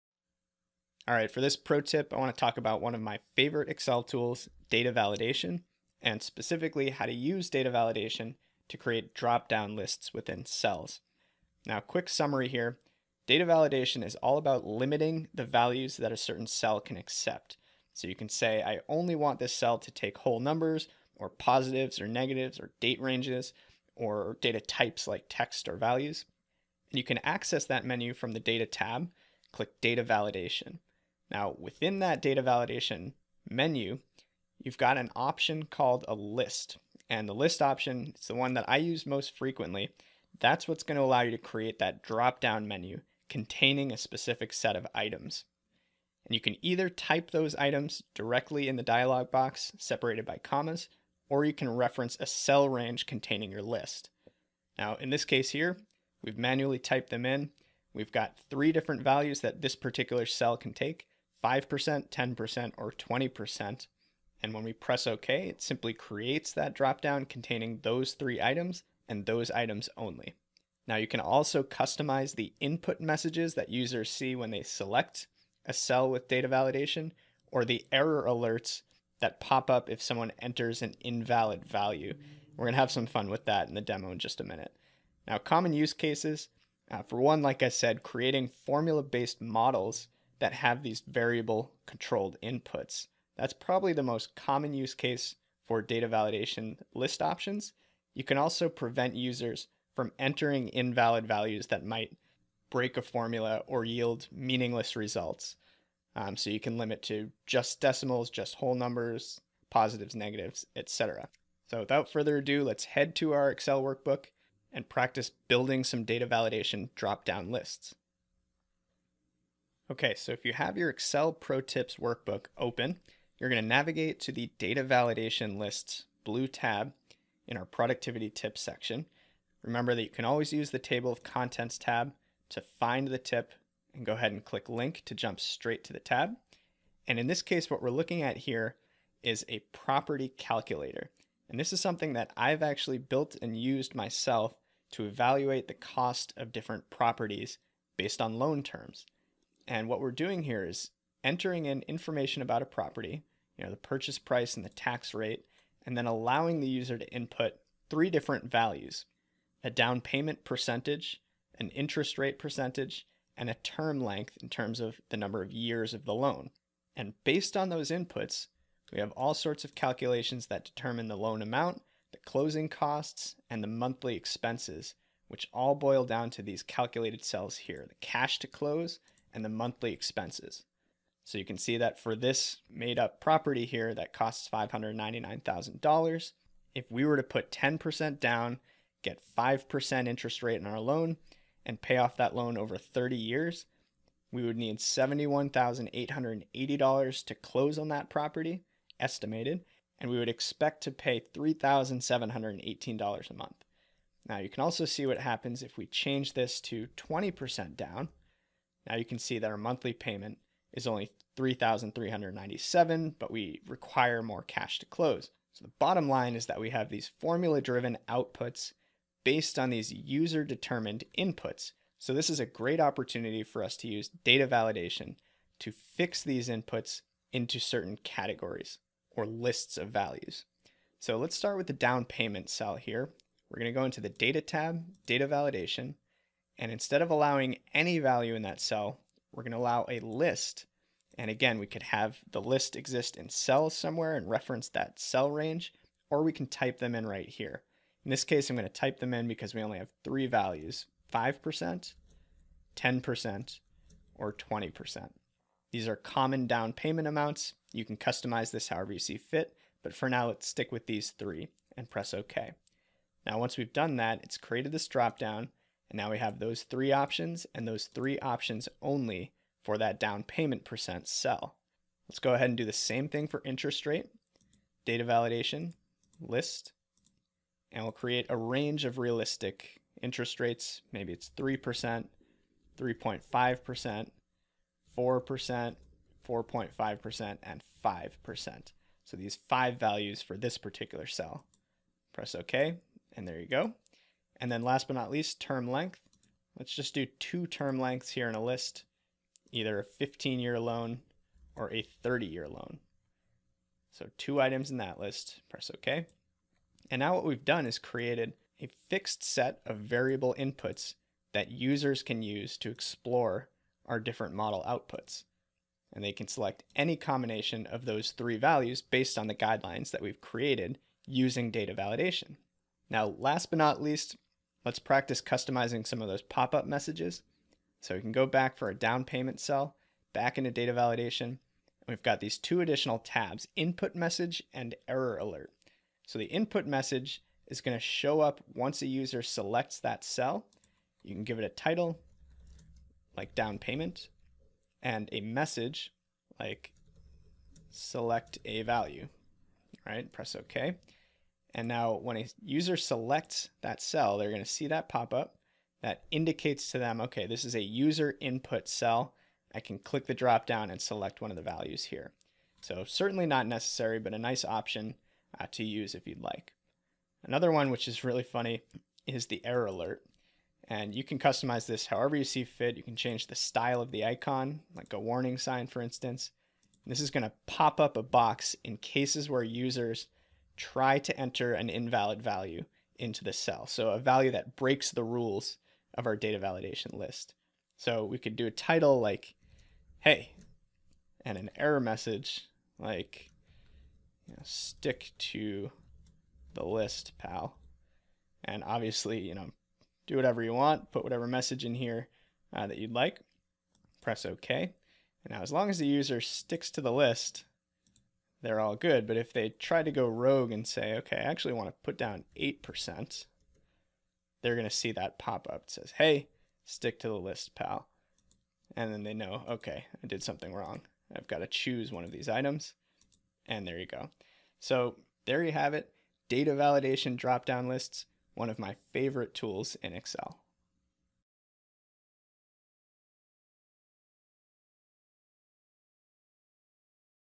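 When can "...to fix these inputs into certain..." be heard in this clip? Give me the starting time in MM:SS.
03:45.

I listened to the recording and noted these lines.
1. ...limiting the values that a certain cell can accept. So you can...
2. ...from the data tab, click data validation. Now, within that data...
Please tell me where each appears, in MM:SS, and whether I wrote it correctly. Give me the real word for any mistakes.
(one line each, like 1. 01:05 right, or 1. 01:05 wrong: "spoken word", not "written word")
1. 00:14 right
2. 00:28 right.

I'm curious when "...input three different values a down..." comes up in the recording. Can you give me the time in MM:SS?
02:37.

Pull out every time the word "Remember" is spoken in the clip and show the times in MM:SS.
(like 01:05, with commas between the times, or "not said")
02:09.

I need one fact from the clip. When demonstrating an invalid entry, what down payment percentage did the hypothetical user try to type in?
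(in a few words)
8%.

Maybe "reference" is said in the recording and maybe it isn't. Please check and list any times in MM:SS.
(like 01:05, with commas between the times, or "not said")
00:51, 04:04.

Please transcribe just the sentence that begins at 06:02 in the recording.
So certainly not necessary, but a nice option uh, to use if you'd like.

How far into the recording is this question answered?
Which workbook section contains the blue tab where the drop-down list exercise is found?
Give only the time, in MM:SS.
02:07.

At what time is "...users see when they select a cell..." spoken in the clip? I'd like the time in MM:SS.
01:13.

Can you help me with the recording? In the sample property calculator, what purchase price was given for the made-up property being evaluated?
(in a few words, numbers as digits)
$599,000.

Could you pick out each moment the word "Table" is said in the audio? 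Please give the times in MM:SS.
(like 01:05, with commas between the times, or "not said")
02:10.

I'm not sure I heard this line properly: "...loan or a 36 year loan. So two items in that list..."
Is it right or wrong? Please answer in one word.
wrong.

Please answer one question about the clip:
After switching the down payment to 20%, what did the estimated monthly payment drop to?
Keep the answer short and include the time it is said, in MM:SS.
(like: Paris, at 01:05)
3,397, at 03:31.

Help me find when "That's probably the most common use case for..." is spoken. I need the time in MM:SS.
01:33.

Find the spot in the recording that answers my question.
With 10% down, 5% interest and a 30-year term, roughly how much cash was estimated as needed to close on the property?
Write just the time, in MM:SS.
03:14.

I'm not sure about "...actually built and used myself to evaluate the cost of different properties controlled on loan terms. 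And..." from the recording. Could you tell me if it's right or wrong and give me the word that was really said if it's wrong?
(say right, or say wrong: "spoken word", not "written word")
wrong: "based", not "controlled".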